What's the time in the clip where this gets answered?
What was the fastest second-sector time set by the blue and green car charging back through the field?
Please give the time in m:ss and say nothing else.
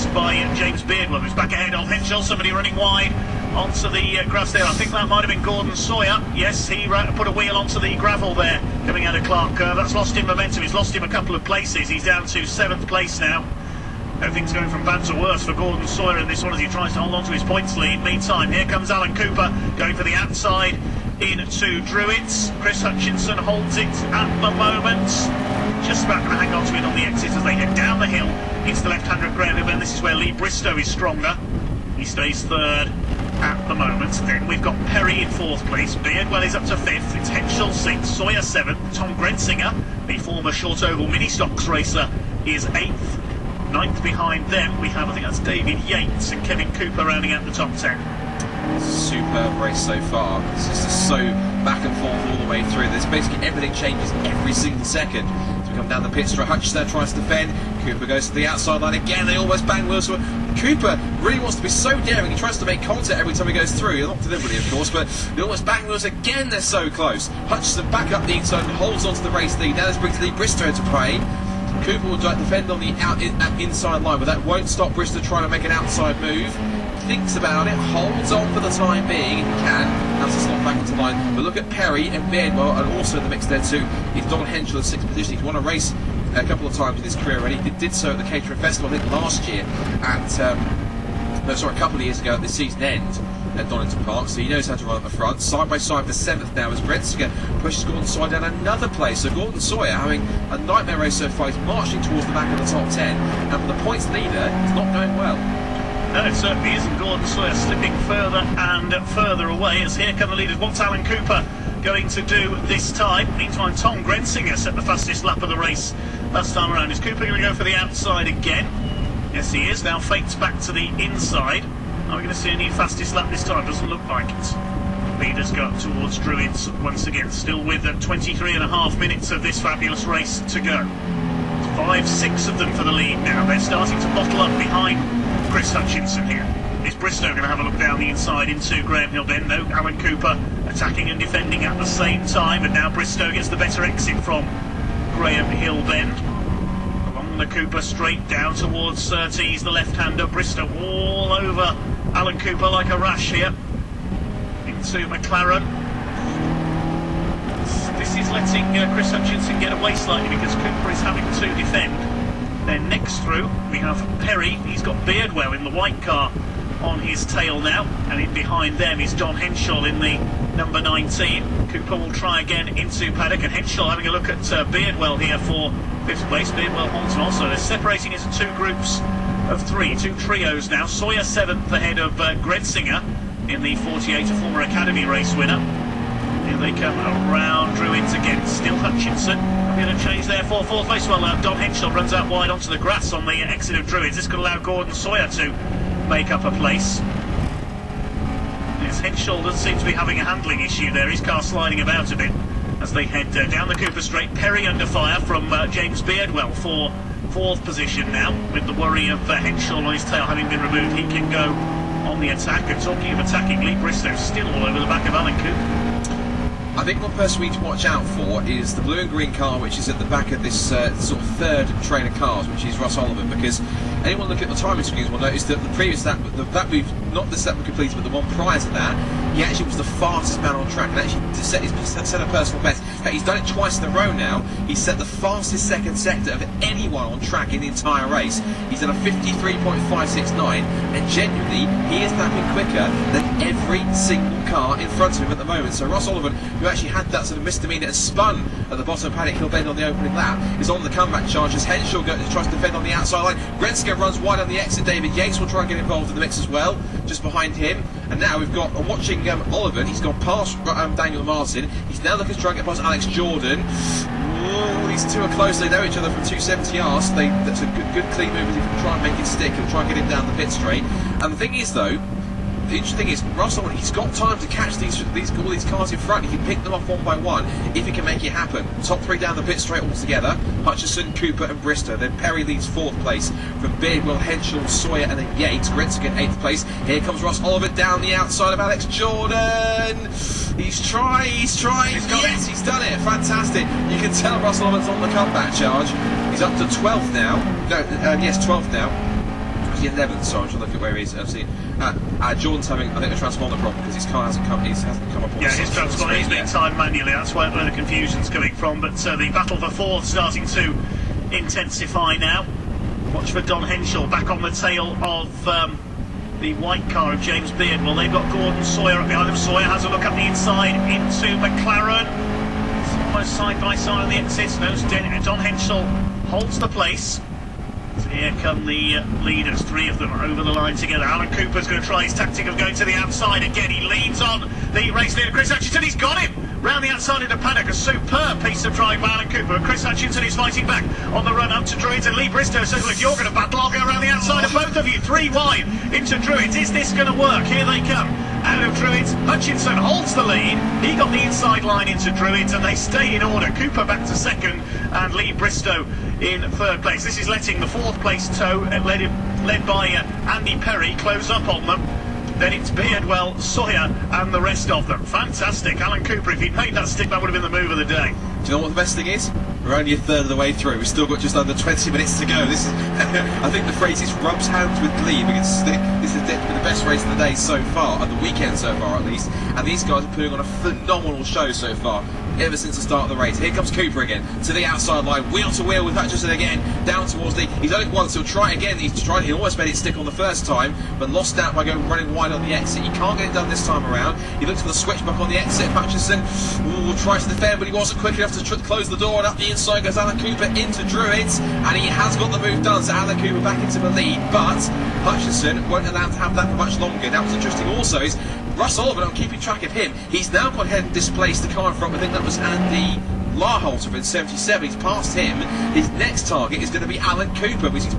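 3:59.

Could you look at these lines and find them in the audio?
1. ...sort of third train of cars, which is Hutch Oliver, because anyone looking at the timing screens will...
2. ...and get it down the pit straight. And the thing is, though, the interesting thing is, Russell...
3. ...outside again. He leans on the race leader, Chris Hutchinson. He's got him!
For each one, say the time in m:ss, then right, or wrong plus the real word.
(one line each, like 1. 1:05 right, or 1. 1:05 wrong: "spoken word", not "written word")
1. 3:40 wrong: "Russ", not "Hutch"
2. 4:29 right
3. 5:32 right.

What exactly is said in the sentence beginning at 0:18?
Meantime, here comes Alan Cooper going for the outside in to Druids.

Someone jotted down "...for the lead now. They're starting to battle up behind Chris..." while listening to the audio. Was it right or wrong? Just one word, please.
wrong.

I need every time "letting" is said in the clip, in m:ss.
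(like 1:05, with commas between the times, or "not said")
2:38, 5:57.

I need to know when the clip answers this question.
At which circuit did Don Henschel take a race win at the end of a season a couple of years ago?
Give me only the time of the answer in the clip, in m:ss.
1:33.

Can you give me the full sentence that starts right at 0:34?
Then we've got Perry in fourth place.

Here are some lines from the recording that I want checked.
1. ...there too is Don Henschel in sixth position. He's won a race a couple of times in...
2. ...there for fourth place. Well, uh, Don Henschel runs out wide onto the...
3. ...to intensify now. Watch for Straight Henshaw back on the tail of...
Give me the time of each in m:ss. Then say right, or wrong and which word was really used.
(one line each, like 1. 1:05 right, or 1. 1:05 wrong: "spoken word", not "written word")
1. 1:23 right
2. 3:10 right
3. 5:10 wrong: "Don", not "Straight".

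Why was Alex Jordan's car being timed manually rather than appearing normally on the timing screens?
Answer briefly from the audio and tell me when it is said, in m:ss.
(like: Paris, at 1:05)
transponder problem, at 5:03.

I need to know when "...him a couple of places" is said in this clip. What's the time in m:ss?
0:10.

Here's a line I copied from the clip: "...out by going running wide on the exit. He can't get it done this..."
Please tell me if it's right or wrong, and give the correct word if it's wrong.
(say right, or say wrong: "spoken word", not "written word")
right.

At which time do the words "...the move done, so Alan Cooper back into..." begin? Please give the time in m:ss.
6:42.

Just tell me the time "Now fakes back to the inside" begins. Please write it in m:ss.
1:59.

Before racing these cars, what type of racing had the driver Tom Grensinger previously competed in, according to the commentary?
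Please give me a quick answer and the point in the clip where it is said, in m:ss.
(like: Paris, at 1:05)
short oval mini stocks, at 0:40.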